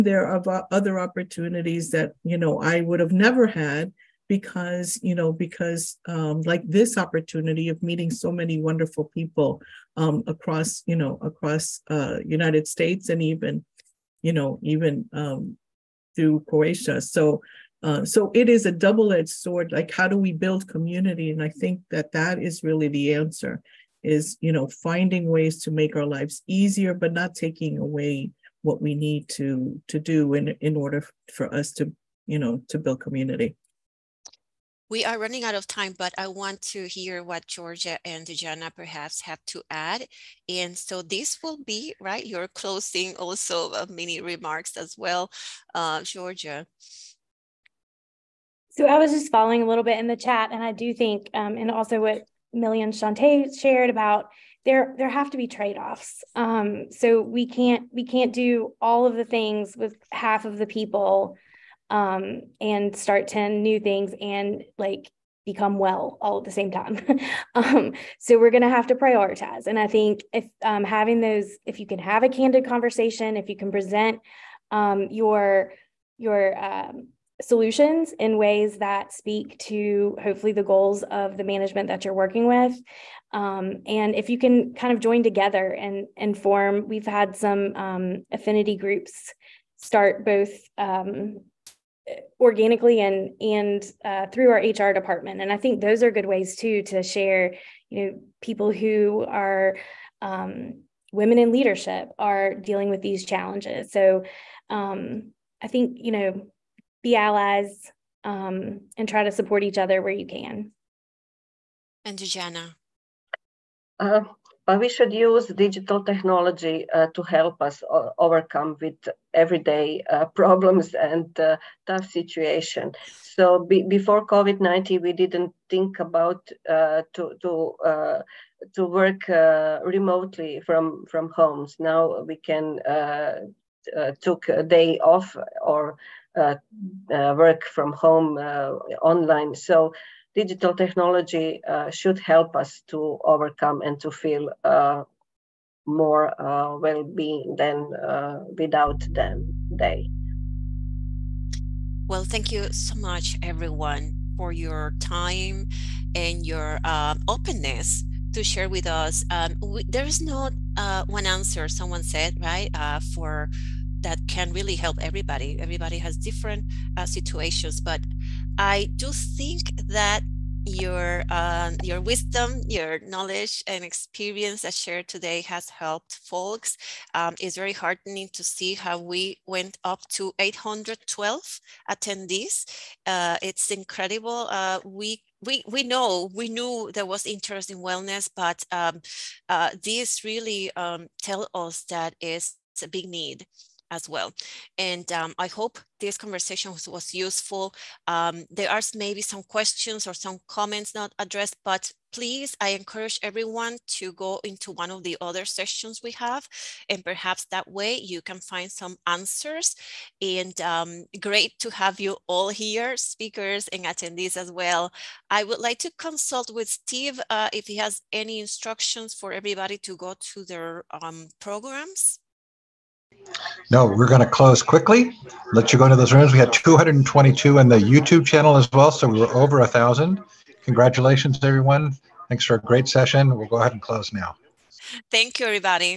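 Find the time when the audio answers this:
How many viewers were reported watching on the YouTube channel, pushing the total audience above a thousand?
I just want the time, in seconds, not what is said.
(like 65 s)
226 s.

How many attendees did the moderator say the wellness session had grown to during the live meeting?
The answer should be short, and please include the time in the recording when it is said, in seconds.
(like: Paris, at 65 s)
812, at 180 s.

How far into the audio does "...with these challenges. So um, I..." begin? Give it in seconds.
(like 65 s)
102 s.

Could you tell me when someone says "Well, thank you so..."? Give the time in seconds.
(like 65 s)
152 s.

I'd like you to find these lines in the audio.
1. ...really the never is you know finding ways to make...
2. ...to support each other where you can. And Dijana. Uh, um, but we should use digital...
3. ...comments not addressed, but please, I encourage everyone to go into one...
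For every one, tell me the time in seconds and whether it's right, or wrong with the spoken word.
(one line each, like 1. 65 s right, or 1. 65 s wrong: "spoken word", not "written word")
1. 22 s wrong: "answer", not "never"
2. 109 s right
3. 200 s right.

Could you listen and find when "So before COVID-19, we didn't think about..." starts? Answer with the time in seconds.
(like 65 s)
123 s.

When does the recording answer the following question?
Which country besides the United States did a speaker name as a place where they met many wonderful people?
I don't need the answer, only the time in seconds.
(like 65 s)
16 s.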